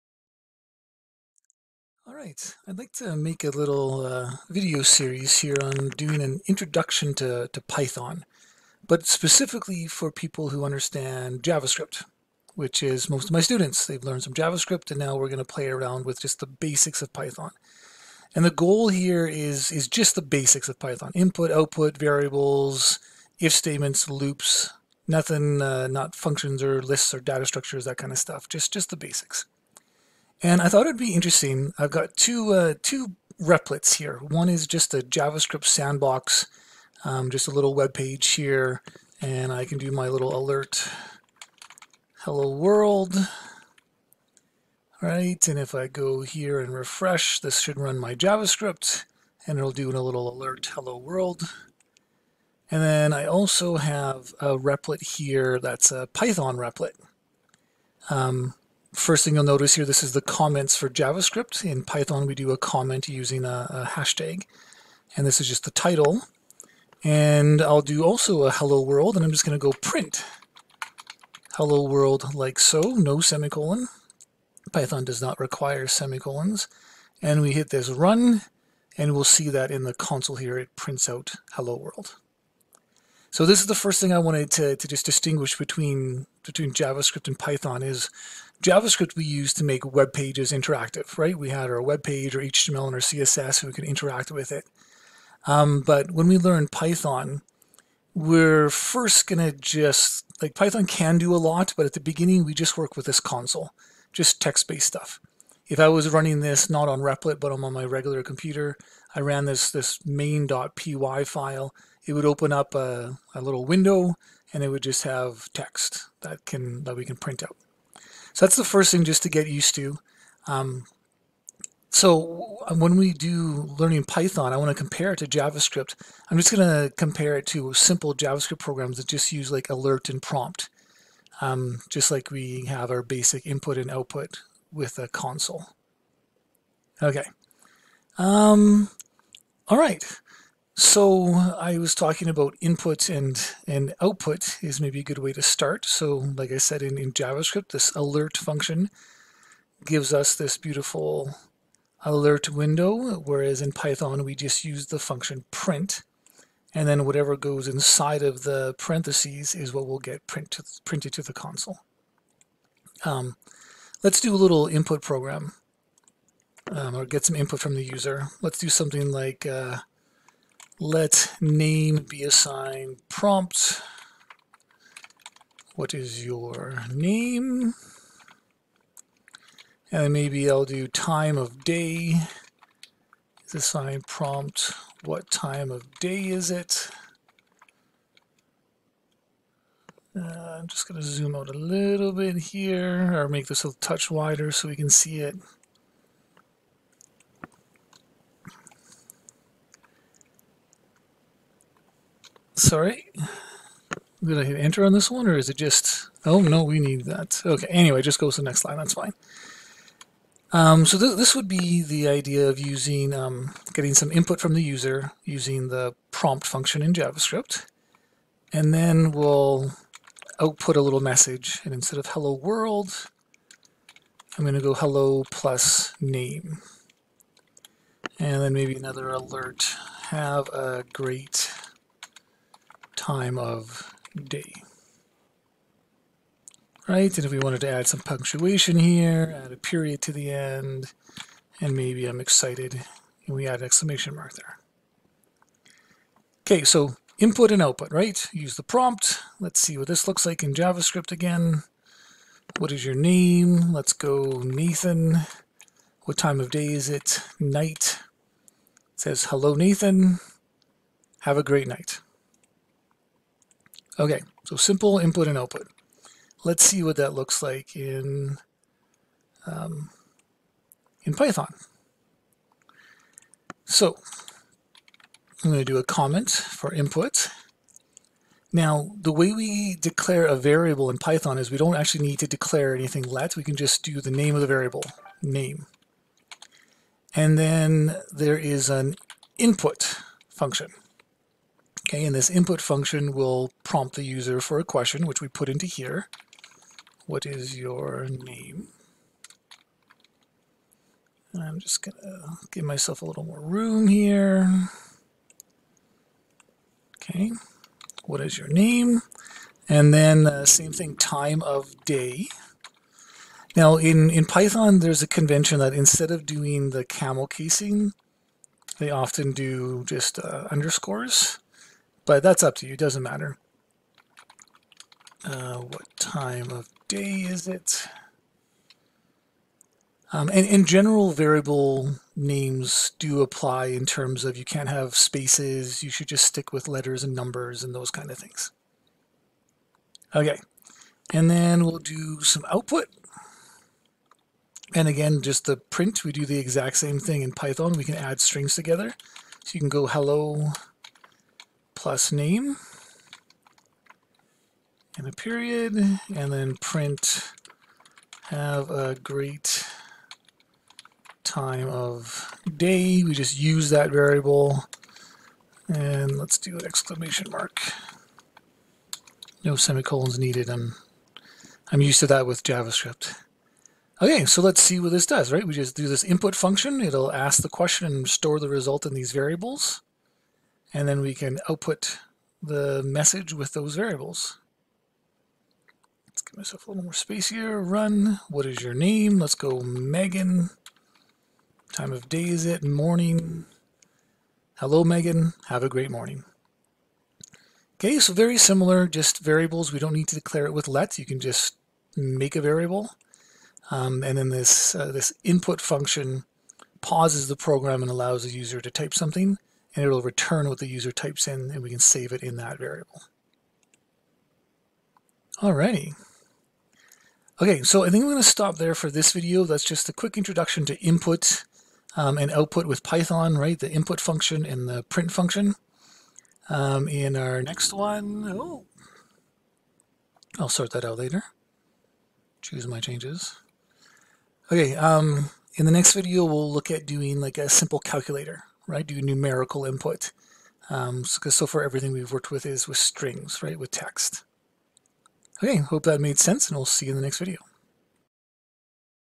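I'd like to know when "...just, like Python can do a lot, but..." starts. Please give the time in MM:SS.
01:39.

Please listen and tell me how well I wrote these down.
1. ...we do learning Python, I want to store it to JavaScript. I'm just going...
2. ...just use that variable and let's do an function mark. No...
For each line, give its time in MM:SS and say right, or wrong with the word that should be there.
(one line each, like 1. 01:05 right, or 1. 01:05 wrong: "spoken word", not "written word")
1. 02:02 wrong: "compare", not "store"
2. 06:03 wrong: "exclamation", not "function".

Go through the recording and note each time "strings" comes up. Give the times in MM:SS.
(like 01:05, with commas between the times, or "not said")
05:48, 07:22.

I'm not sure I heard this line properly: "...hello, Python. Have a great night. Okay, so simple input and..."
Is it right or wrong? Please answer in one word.
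wrong.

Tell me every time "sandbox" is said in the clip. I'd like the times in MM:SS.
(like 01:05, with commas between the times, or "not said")
00:35.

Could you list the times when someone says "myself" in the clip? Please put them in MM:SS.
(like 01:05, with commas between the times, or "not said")
05:02, 06:26.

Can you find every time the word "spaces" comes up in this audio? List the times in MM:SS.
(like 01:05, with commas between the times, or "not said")
05:34, 06:26.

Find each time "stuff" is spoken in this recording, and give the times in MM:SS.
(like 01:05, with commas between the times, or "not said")
00:28, 01:44.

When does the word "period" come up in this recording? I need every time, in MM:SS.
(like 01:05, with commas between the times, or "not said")
03:59, 05:55.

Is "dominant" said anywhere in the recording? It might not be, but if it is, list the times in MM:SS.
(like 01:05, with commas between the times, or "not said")
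not said.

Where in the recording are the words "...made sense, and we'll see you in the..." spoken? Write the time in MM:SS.
07:25.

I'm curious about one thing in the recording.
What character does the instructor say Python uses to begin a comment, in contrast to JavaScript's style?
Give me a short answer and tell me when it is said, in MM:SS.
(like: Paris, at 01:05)
hashtag, at 01:03.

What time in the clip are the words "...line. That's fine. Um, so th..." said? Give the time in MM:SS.
03:28.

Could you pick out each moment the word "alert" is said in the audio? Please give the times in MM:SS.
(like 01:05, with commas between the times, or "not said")
00:40, 00:50, 02:09, 02:27, 02:32, 03:49.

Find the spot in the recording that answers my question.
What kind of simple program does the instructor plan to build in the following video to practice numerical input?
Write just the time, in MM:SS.
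07:17.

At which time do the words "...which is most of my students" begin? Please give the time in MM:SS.
00:12.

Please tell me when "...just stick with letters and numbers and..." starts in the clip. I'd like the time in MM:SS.
05:36.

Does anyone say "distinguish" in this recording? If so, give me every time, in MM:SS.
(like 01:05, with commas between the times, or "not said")
01:25.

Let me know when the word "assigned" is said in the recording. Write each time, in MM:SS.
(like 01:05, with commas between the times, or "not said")
02:52, 03:03.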